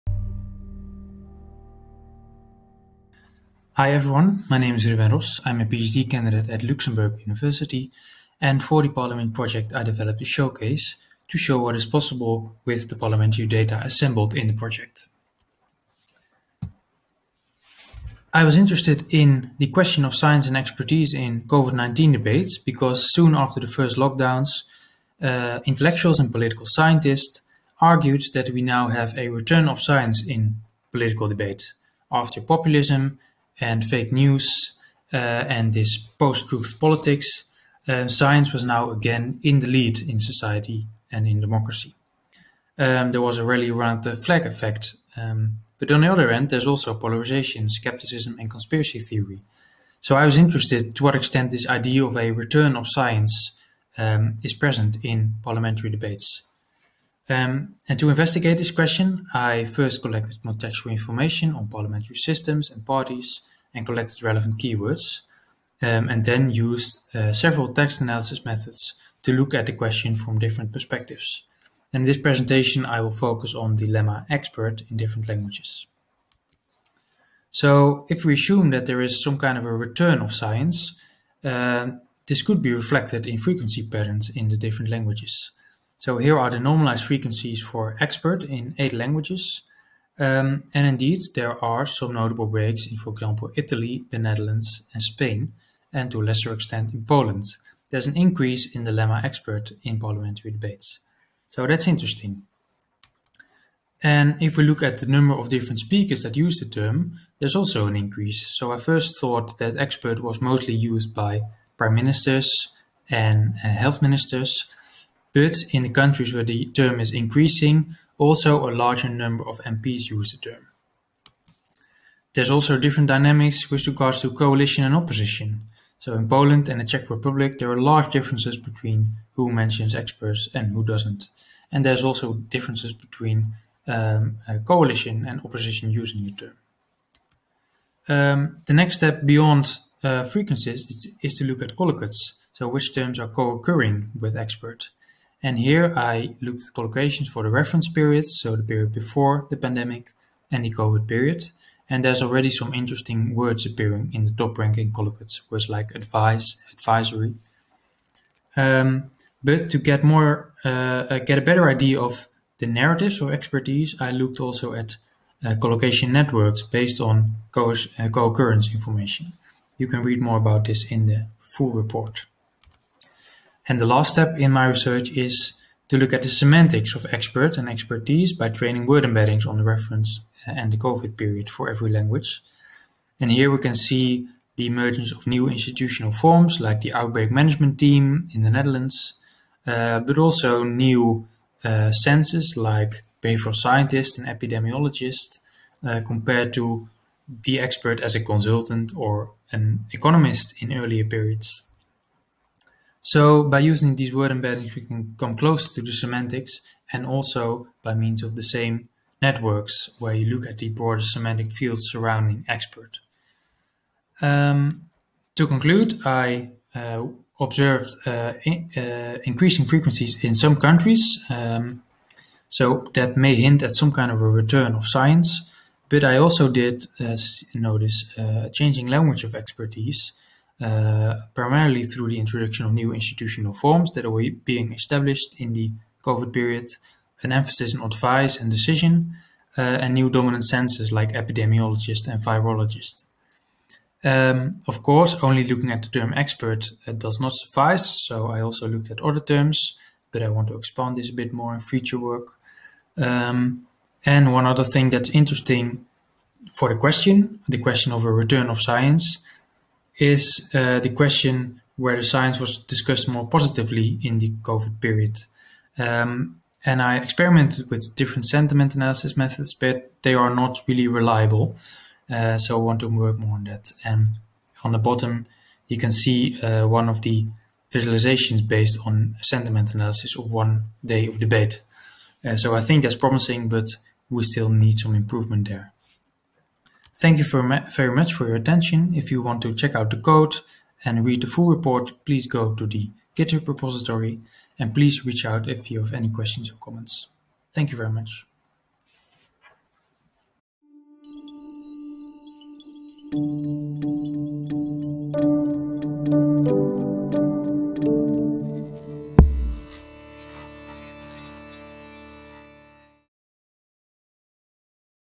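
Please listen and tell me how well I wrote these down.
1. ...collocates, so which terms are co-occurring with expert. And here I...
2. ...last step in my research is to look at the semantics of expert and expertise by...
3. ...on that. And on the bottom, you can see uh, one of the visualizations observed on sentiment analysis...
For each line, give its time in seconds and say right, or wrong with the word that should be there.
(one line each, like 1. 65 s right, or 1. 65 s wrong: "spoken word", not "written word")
1. 141 s right
2. 173 s right
3. 273 s wrong: "based", not "observed".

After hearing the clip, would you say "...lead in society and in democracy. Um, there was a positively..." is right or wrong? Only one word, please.
wrong.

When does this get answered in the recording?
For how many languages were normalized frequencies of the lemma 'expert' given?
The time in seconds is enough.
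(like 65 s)
88 s.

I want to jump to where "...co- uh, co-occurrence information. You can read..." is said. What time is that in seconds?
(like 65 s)
167 s.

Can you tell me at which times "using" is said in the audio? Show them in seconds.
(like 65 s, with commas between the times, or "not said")
135 s, 203 s.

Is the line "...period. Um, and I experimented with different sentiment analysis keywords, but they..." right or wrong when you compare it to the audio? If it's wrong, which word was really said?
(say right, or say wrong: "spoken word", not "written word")
wrong: "methods", not "keywords".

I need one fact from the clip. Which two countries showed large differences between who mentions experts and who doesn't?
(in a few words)
Poland and the Czech Republic.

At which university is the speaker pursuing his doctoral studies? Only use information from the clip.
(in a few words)
Luxembourg University.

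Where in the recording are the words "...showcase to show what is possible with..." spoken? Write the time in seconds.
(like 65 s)
10 s.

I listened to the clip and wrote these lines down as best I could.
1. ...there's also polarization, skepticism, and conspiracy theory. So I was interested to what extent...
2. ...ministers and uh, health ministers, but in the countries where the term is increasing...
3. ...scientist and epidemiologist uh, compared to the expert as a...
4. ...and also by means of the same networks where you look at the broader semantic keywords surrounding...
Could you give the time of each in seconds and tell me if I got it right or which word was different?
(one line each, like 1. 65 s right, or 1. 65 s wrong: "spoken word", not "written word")
1. 46 s right
2. 111 s right
3. 193 s right
4. 206 s wrong: "fields", not "keywords".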